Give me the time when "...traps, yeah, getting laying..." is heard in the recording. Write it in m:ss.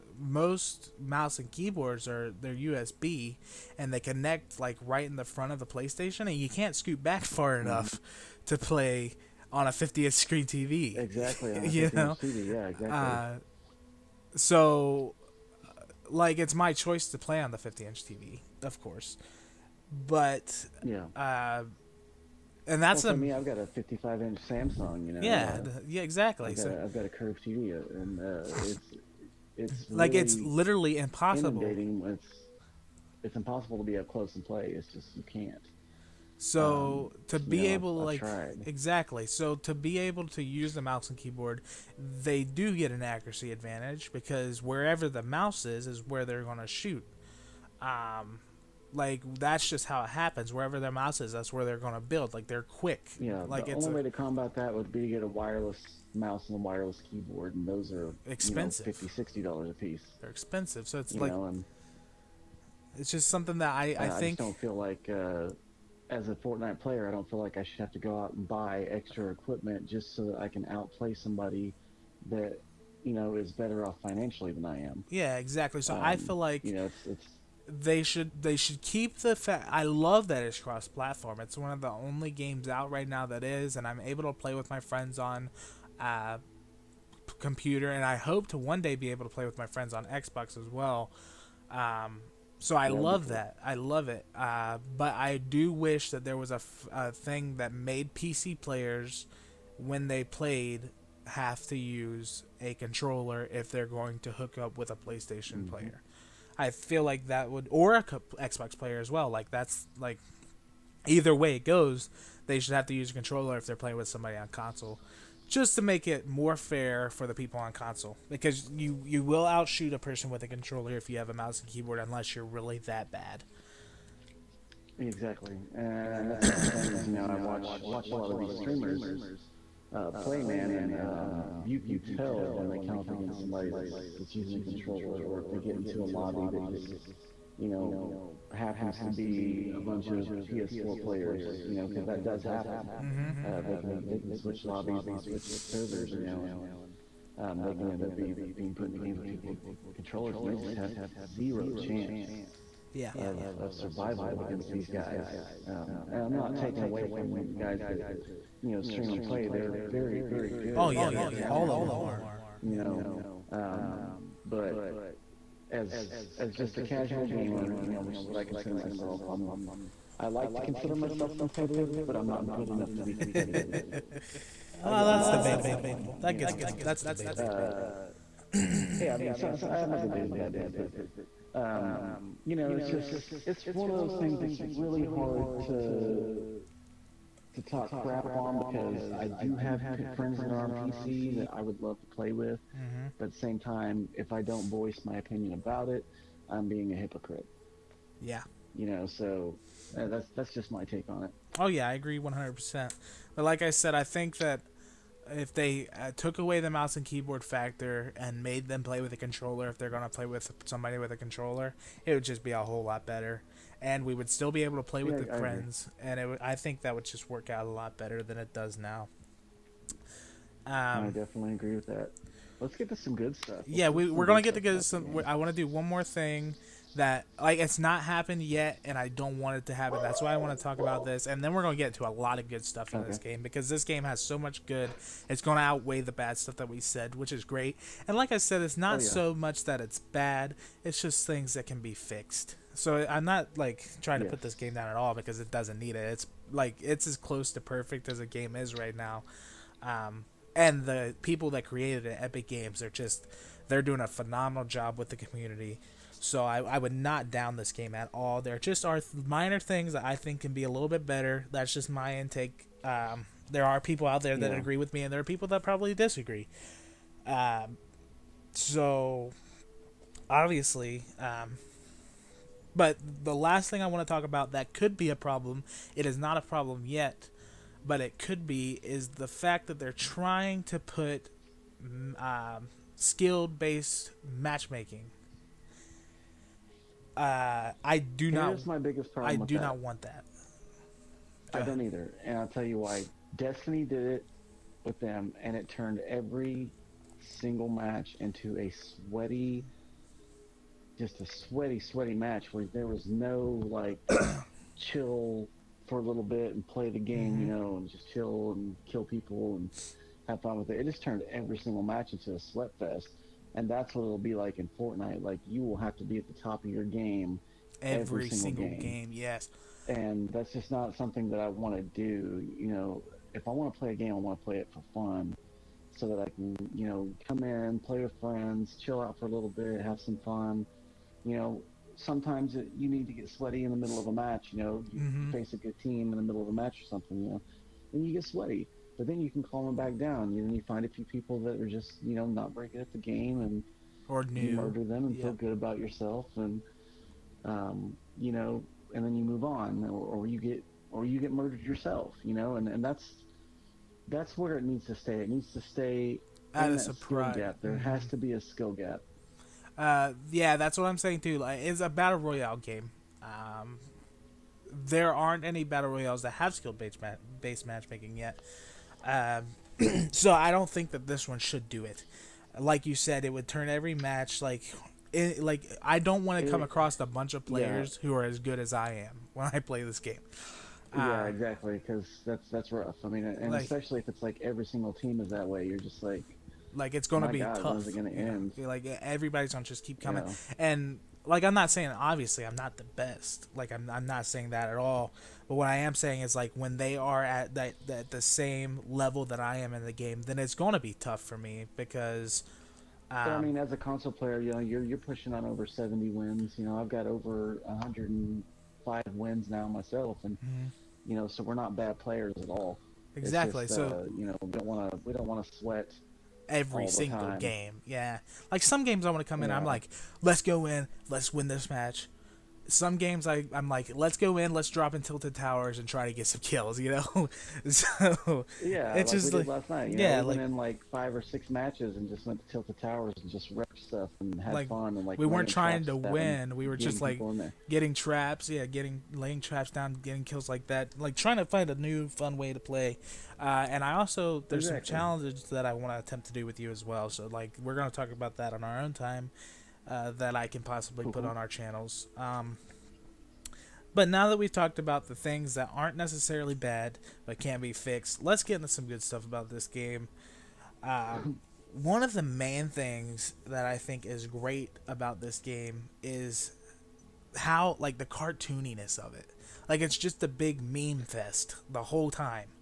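7:17.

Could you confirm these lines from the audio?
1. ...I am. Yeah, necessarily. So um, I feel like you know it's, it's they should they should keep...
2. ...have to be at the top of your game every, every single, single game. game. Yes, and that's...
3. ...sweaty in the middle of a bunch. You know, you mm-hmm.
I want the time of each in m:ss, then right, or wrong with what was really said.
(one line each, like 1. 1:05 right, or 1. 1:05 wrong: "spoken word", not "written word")
1. 1:14 wrong: "exactly", not "necessarily"
2. 5:15 right
3. 5:33 wrong: "match", not "bunch".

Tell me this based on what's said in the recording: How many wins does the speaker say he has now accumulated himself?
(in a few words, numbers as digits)
over 105.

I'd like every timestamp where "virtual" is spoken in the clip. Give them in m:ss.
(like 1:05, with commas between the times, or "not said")
not said.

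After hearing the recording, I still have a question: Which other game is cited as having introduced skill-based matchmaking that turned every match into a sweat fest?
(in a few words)
Destiny.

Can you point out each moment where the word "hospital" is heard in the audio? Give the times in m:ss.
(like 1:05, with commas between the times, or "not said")
not said.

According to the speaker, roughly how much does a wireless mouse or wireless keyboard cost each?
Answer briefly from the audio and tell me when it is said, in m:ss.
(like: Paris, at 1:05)
$50-60, at 0:58.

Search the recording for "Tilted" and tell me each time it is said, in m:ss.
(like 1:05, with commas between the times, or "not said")
7:05, 7:12.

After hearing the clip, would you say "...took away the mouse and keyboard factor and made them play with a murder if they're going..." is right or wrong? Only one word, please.
wrong.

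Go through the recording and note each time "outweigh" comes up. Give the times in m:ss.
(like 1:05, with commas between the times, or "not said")
3:55.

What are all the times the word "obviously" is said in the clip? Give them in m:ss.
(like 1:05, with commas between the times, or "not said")
4:30, 6:31.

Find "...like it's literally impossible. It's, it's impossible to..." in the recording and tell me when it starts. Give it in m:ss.
0:29.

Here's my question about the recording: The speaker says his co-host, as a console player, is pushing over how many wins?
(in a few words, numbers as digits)
70.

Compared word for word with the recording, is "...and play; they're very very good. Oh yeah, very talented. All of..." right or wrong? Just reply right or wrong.
right.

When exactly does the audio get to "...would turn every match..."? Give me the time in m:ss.
6:13.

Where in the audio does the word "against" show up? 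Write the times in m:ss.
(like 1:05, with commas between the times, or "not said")
2:13, 2:34.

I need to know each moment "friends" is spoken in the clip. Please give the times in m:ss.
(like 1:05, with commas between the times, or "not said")
1:24, 1:29, 3:10, 3:35, 5:28.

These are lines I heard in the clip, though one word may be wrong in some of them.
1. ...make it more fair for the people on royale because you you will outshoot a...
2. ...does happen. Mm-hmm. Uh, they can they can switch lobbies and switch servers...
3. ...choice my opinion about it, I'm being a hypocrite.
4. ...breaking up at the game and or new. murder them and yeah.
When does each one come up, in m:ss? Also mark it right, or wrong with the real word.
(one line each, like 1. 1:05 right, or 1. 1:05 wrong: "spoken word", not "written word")
1. 1:55 wrong: "console", not "royale"
2. 2:22 right
3. 3:14 wrong: "voice", not "choice"
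4. 5:42 right.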